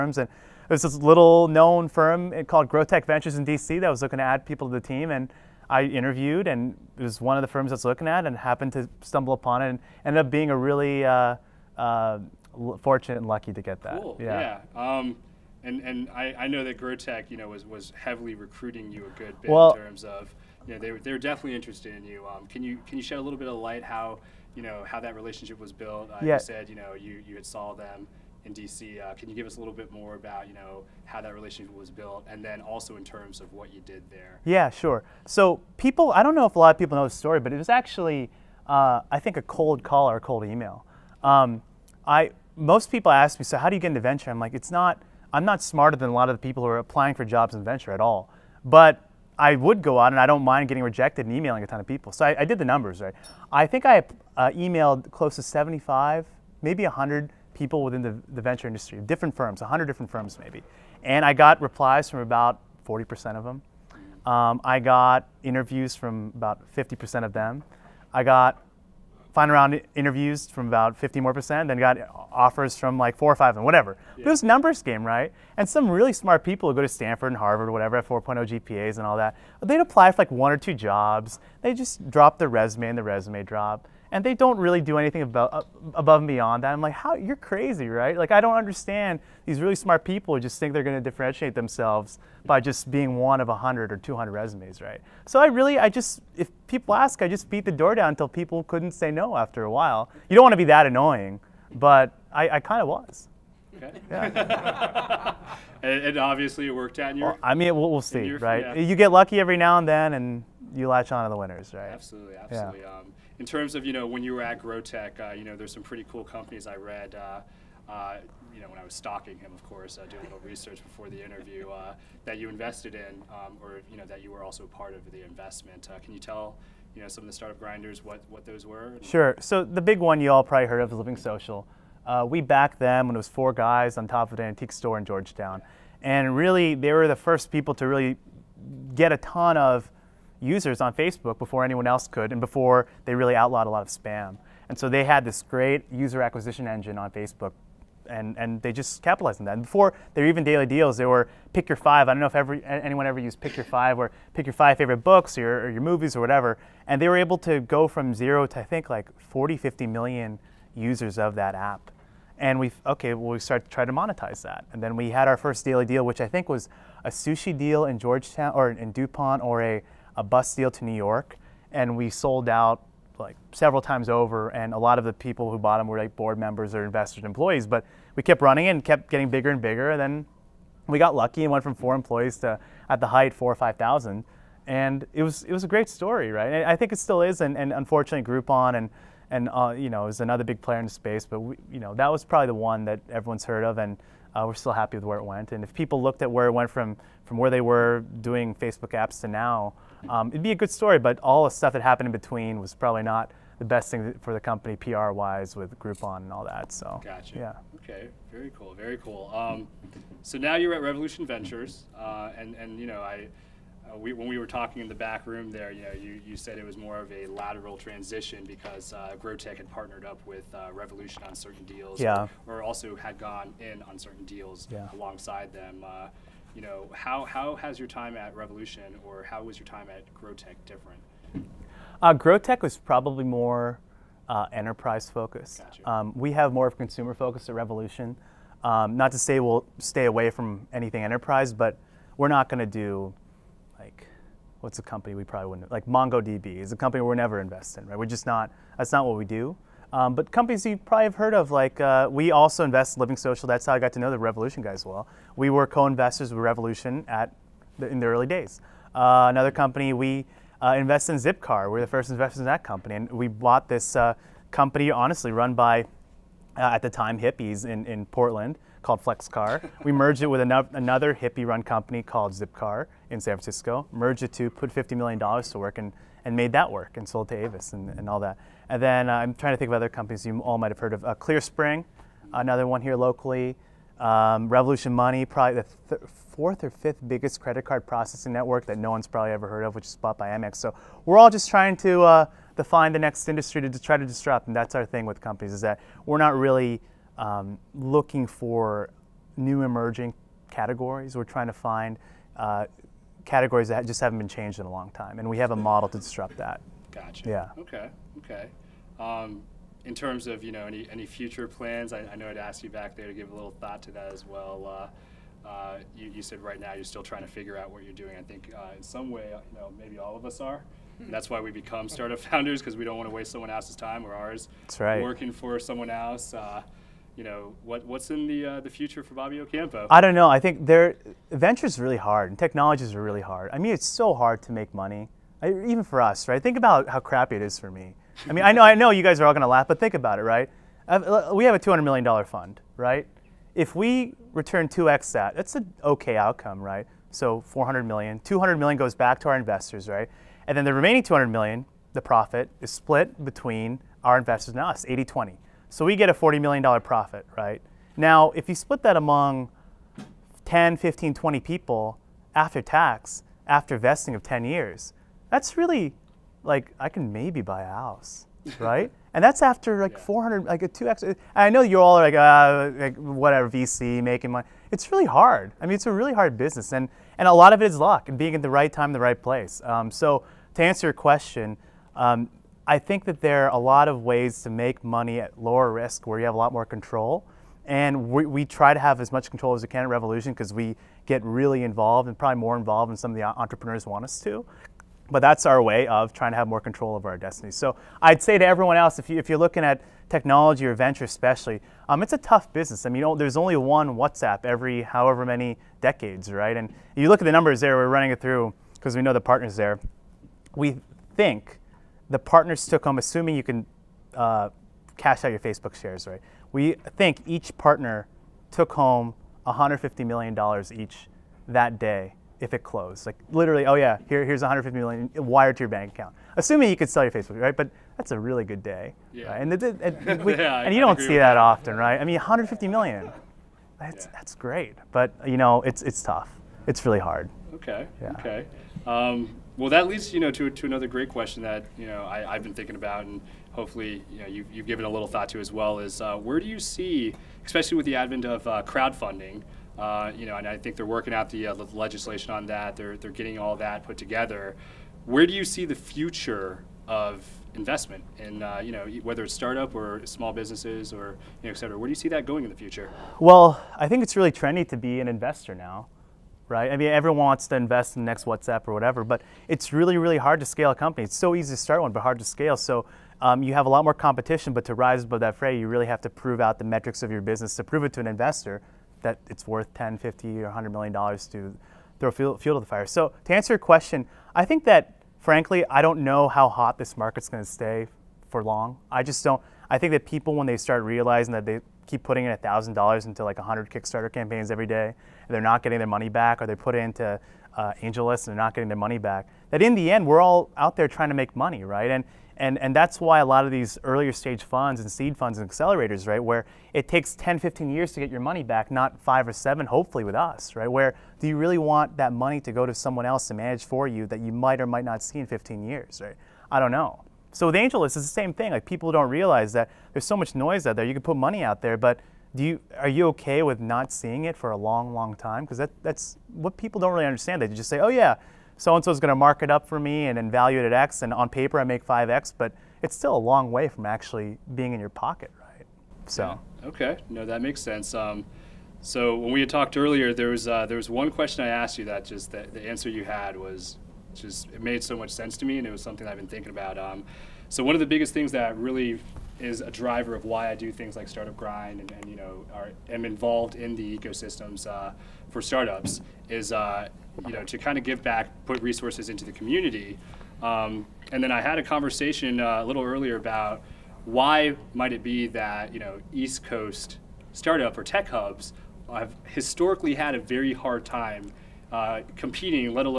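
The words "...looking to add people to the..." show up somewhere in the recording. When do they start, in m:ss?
0:04.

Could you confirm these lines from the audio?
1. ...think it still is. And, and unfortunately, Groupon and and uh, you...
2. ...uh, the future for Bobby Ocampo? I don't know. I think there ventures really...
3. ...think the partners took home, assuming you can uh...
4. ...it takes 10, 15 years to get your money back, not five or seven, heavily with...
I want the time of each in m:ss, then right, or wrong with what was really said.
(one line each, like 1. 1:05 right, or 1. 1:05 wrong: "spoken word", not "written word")
1. 3:06 right
2. 5:28 right
3. 6:51 right
4. 8:26 wrong: "hopefully", not "heavily".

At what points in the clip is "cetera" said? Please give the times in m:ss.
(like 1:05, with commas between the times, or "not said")
7:41.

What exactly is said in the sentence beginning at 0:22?
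Um, can you can you shed a little bit of light how you know how that relationship was built?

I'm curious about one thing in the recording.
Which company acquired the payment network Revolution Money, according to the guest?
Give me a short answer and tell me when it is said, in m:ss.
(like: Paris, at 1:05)
Amex, at 4:50.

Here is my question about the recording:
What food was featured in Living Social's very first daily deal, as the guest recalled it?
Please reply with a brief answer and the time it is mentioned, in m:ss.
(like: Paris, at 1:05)
sushi, at 2:47.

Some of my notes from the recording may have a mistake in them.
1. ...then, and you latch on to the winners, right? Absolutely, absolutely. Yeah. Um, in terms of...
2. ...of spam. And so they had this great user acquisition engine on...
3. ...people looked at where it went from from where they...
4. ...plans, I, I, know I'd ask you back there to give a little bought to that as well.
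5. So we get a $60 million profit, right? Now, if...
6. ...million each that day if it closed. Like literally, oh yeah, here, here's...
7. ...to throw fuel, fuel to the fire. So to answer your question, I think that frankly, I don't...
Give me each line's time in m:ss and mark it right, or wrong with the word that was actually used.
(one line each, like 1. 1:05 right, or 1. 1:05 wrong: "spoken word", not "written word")
1. 1:49 right
2. 2:23 right
3. 3:15 right
4. 5:11 wrong: "thought", not "bought"
5. 5:55 wrong: "40", not "60"
6. 7:00 right
7. 8:01 right.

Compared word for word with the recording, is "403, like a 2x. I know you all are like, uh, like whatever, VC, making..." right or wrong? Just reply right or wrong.
wrong.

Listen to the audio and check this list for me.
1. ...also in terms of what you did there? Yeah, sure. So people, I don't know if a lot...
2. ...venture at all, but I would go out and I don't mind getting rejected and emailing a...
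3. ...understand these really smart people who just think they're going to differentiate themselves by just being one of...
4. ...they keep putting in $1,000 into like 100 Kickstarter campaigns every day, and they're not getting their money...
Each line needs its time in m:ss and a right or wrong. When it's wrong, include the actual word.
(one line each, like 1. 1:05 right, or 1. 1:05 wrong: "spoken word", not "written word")
1. 0:32 right
2. 0:47 right
3. 1:28 right
4. 8:11 right.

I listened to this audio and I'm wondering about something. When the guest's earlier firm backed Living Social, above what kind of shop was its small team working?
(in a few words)
an antique store.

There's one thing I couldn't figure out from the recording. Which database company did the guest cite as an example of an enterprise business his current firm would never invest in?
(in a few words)
MongoDB.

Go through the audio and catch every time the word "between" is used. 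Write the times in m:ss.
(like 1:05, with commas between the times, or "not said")
3:22, 5:53.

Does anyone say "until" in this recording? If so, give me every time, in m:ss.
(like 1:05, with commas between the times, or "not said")
1:38.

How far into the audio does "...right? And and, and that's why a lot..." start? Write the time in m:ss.
8:21.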